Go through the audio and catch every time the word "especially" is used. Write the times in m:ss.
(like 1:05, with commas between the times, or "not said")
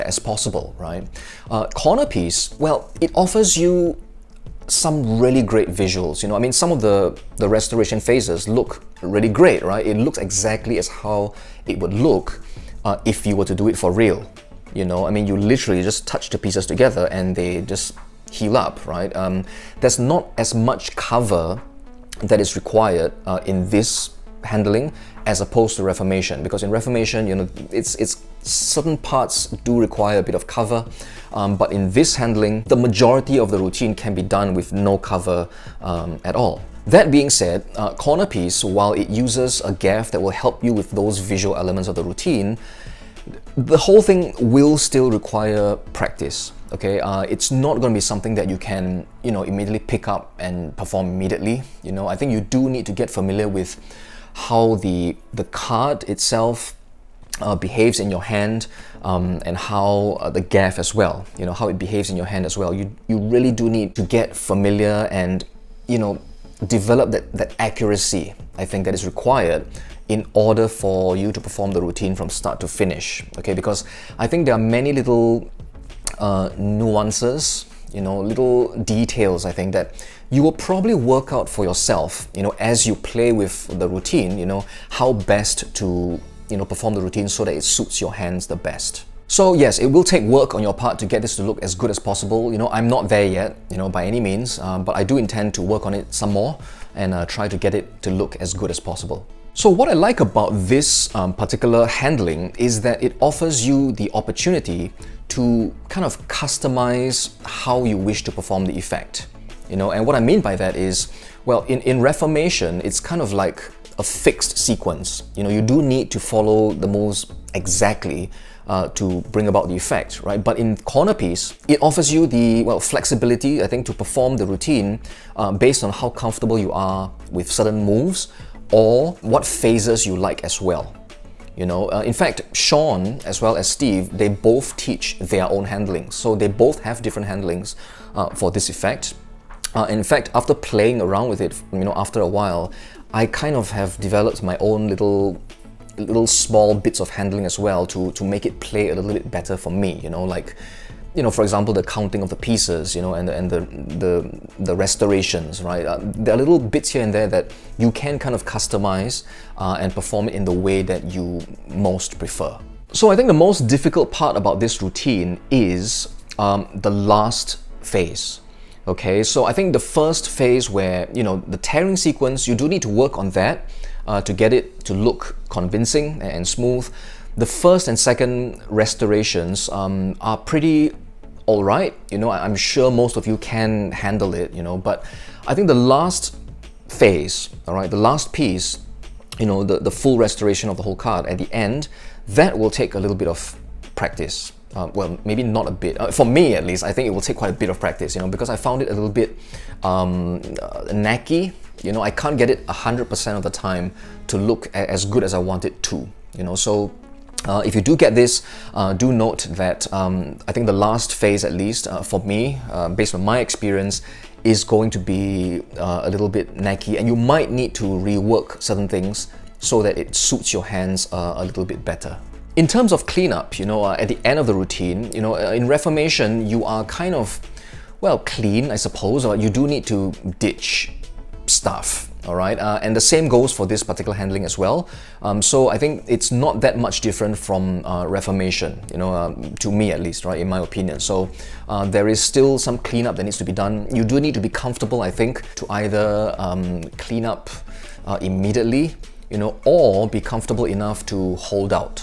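not said.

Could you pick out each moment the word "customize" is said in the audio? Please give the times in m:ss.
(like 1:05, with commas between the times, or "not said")
1:46, 2:38.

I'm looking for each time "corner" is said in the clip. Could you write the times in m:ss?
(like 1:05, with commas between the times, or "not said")
0:01, 0:37, 2:00.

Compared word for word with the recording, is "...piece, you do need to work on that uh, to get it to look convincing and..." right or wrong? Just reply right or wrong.
wrong.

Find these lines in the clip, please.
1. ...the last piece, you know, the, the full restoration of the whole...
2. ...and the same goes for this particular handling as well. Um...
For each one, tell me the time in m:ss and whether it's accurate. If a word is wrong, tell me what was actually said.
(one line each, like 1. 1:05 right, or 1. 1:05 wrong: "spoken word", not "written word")
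1. 3:07 right
2. 3:52 right.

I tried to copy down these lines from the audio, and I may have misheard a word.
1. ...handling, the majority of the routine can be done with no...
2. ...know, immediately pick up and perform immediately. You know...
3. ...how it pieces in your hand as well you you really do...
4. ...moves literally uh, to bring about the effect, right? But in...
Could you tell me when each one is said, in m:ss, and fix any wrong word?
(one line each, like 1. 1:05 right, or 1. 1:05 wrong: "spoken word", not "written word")
1. 0:32 right
2. 0:49 right
3. 1:01 wrong: "behaves", not "pieces"
4. 1:56 wrong: "exactly", not "literally".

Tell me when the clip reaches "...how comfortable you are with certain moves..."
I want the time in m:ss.
2:05.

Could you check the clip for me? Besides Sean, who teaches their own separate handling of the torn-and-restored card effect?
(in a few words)
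Steve.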